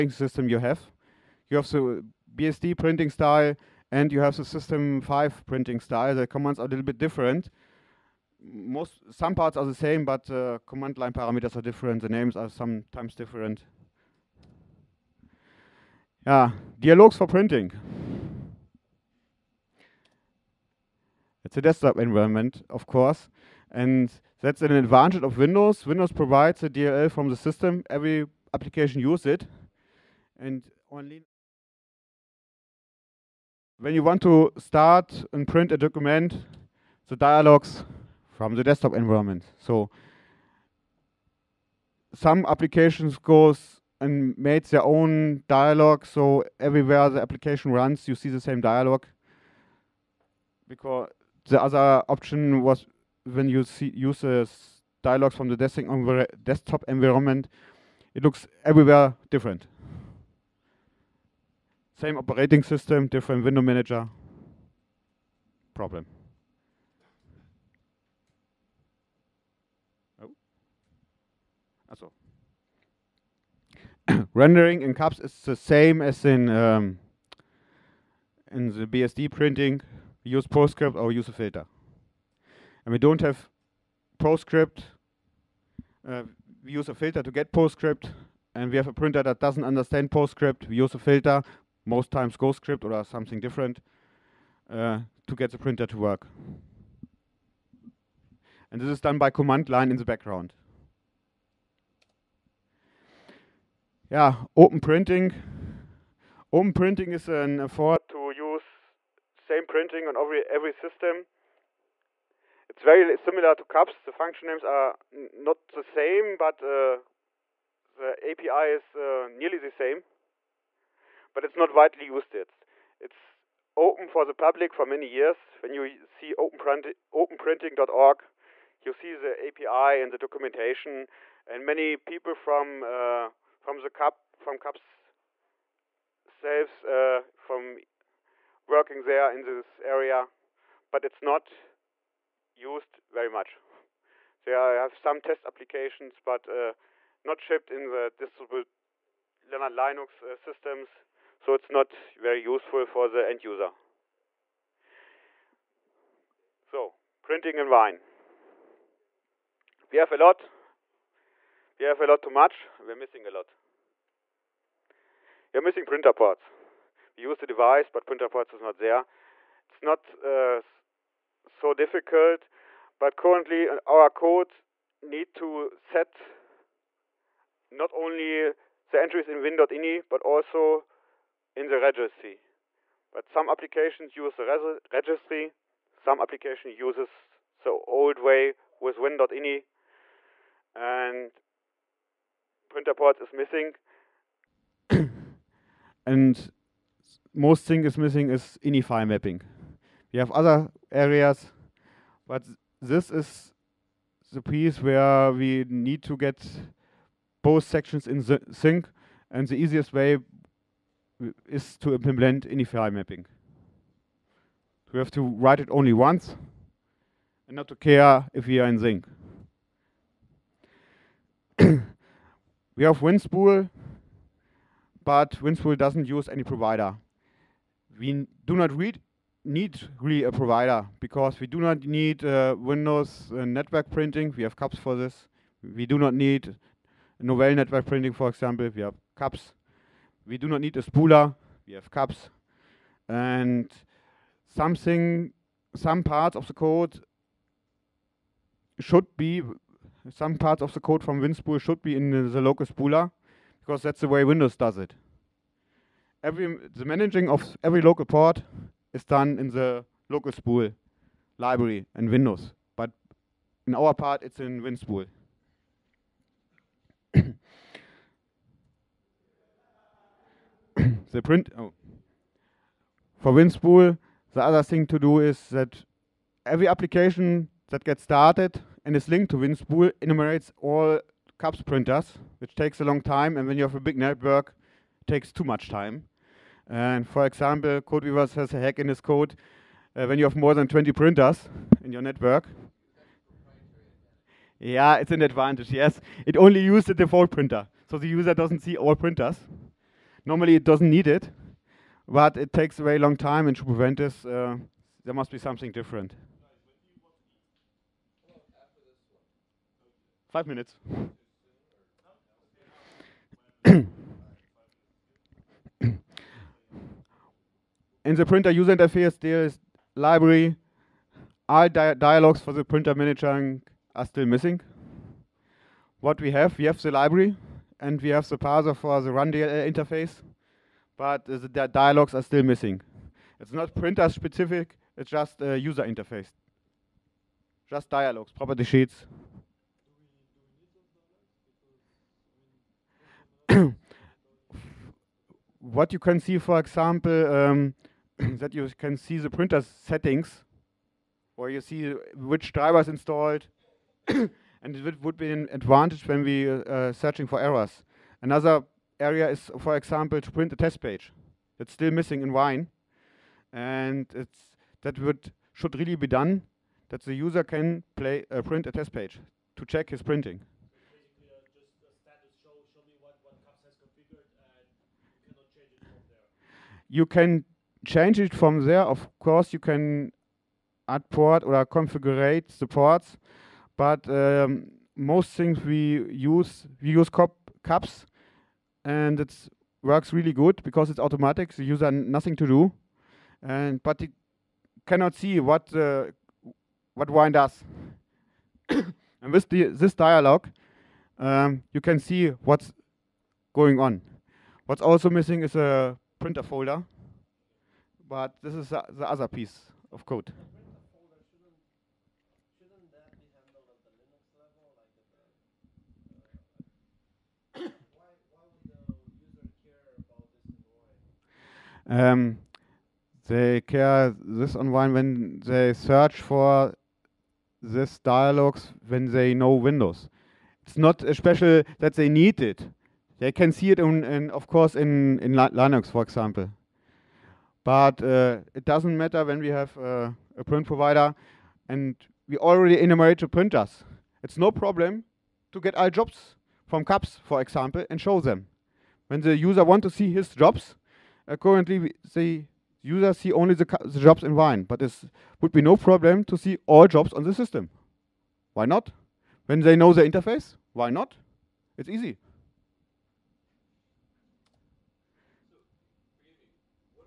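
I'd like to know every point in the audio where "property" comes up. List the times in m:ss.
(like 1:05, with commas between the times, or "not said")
5:38.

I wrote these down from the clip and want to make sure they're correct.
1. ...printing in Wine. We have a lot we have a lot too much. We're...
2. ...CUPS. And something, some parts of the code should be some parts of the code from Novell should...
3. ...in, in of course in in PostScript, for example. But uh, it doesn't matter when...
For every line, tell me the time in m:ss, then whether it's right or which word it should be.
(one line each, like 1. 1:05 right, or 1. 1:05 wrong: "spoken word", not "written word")
1. 2:37 right
2. 4:01 wrong: "WinSpool", not "Novell"
3. 7:13 wrong: "Linux", not "PostScript".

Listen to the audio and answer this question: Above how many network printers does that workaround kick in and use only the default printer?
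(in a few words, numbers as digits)
20.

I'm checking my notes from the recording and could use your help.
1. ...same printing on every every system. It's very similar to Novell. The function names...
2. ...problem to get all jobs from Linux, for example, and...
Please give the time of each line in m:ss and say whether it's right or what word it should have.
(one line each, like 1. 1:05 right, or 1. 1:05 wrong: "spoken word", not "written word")
1. 1:49 wrong: "CUPS", not "Novell"
2. 7:24 wrong: "CUPS", not "Linux".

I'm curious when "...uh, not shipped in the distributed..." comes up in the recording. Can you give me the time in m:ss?
2:26.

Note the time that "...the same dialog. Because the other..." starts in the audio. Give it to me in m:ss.
0:48.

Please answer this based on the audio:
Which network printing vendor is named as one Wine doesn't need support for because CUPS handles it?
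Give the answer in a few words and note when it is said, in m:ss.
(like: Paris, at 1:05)
Novell, at 3:57.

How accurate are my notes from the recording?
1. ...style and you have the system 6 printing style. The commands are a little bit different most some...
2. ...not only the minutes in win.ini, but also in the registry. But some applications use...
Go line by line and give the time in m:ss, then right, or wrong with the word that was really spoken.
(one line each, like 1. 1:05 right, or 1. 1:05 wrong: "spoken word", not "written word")
1. 0:03 wrong: "5", not "6"
2. 2:57 wrong: "entries", not "minutes".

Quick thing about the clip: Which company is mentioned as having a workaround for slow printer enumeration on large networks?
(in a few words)
CodeWeavers.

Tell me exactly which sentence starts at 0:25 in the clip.
Windows provides a DLL from the system.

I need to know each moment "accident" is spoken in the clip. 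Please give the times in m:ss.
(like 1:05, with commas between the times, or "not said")
not said.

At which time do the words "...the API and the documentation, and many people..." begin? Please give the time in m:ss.
2:09.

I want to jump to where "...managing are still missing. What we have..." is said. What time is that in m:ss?
5:22.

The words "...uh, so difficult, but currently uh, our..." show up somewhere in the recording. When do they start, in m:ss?
2:50.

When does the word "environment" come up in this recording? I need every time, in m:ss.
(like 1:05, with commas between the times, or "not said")
0:21, 0:38, 0:56.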